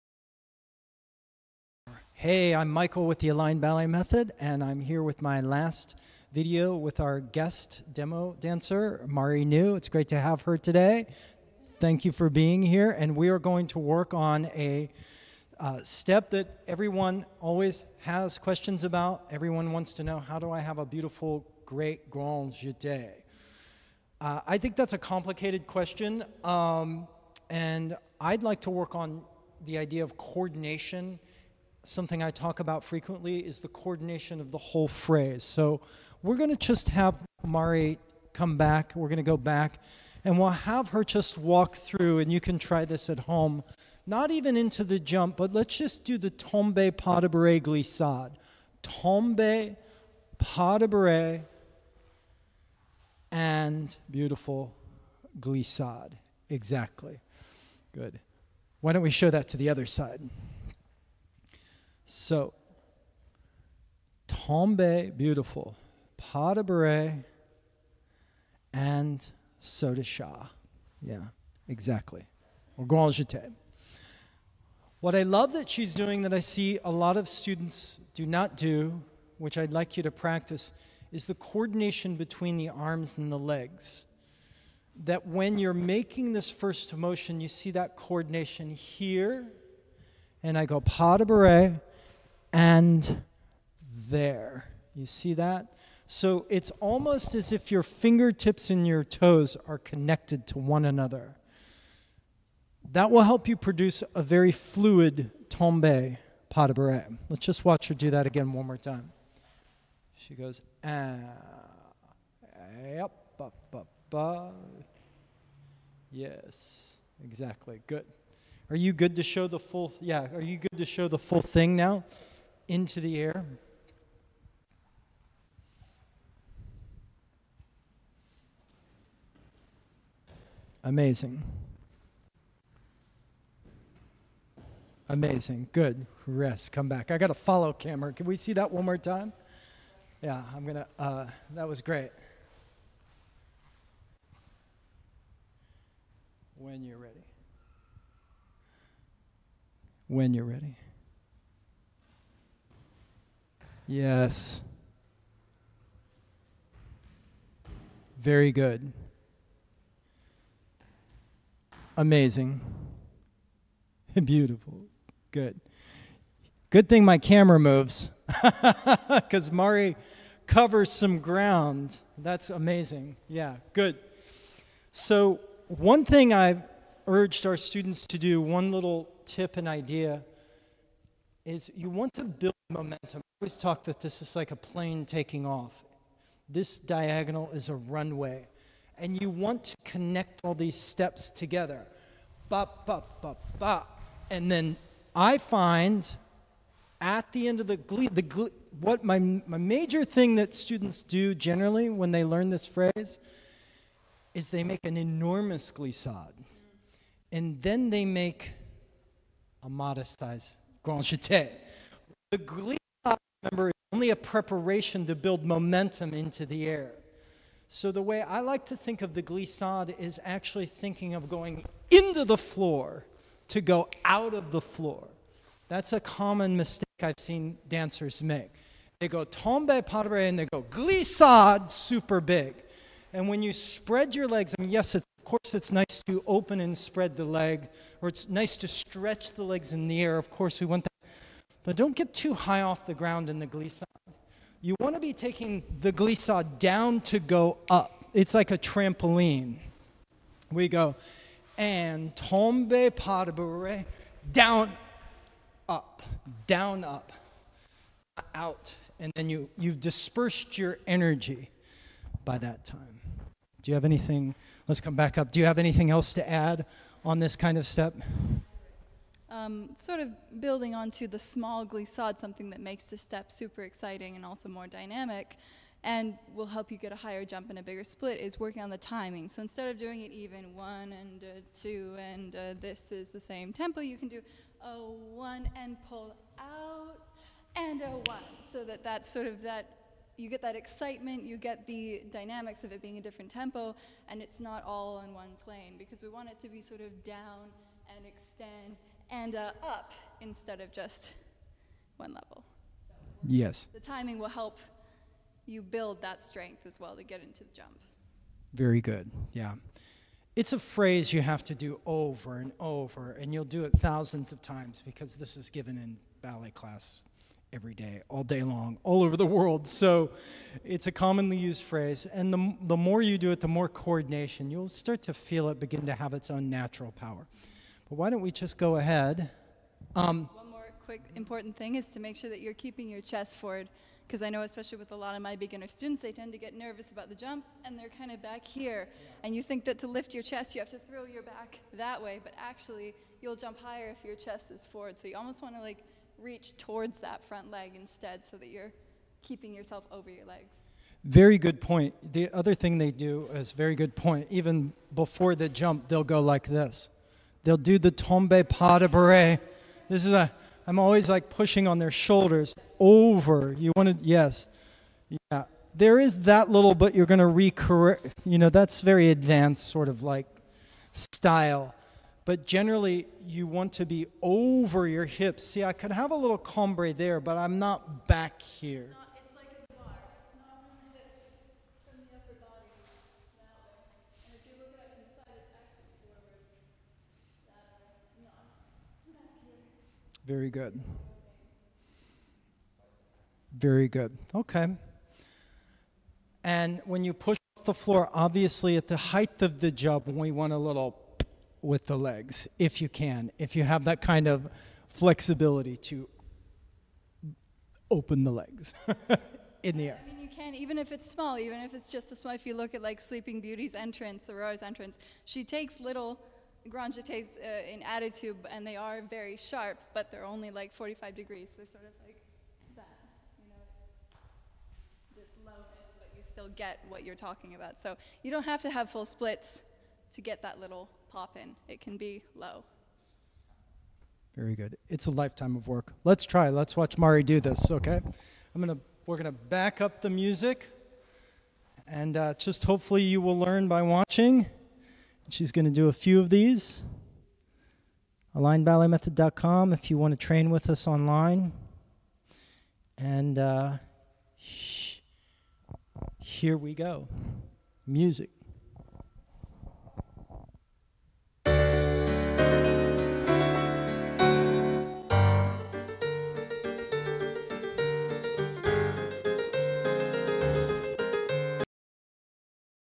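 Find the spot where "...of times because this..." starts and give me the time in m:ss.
5:14.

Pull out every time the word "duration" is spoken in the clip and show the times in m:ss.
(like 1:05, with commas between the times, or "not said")
not said.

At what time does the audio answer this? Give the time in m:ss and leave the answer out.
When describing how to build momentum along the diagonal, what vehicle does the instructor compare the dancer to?
3:04.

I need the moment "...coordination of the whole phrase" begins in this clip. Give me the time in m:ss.
0:33.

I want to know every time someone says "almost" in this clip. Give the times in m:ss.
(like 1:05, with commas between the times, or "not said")
1:36, 5:45.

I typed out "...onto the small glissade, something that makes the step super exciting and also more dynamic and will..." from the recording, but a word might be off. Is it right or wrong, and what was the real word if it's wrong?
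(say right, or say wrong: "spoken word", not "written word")
right.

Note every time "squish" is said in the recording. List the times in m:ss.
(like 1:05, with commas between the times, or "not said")
not said.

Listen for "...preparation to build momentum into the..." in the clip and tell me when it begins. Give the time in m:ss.
3:34.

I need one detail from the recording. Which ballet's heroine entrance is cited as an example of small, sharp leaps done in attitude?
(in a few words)
Sleeping Beauty.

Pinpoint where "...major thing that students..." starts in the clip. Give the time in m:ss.
3:19.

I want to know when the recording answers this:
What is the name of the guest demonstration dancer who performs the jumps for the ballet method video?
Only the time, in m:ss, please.
0:09.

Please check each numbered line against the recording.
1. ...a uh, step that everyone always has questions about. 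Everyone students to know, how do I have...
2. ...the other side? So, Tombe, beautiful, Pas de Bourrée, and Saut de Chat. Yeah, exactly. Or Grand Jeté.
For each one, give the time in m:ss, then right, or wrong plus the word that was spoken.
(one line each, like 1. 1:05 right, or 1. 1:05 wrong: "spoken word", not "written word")
1. 0:14 wrong: "wants", not "students"
2. 0:59 right.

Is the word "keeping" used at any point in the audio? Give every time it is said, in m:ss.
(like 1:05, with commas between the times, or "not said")
5:32, 5:49.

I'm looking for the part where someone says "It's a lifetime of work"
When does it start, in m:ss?
7:14.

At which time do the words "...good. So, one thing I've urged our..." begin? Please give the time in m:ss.
2:53.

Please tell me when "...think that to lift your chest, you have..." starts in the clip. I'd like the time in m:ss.
5:39.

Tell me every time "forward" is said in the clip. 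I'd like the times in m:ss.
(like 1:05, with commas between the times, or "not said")
5:33, 5:44.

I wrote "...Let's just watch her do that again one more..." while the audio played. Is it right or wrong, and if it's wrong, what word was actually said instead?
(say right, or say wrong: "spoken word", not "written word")
right.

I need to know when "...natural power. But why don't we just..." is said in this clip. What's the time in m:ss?
5:26.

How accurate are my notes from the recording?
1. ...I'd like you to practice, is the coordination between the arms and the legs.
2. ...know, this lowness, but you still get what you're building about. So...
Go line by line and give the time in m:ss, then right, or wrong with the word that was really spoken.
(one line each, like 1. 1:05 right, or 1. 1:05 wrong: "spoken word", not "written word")
1. 1:19 right
2. 7:03 wrong: "talking", not "building".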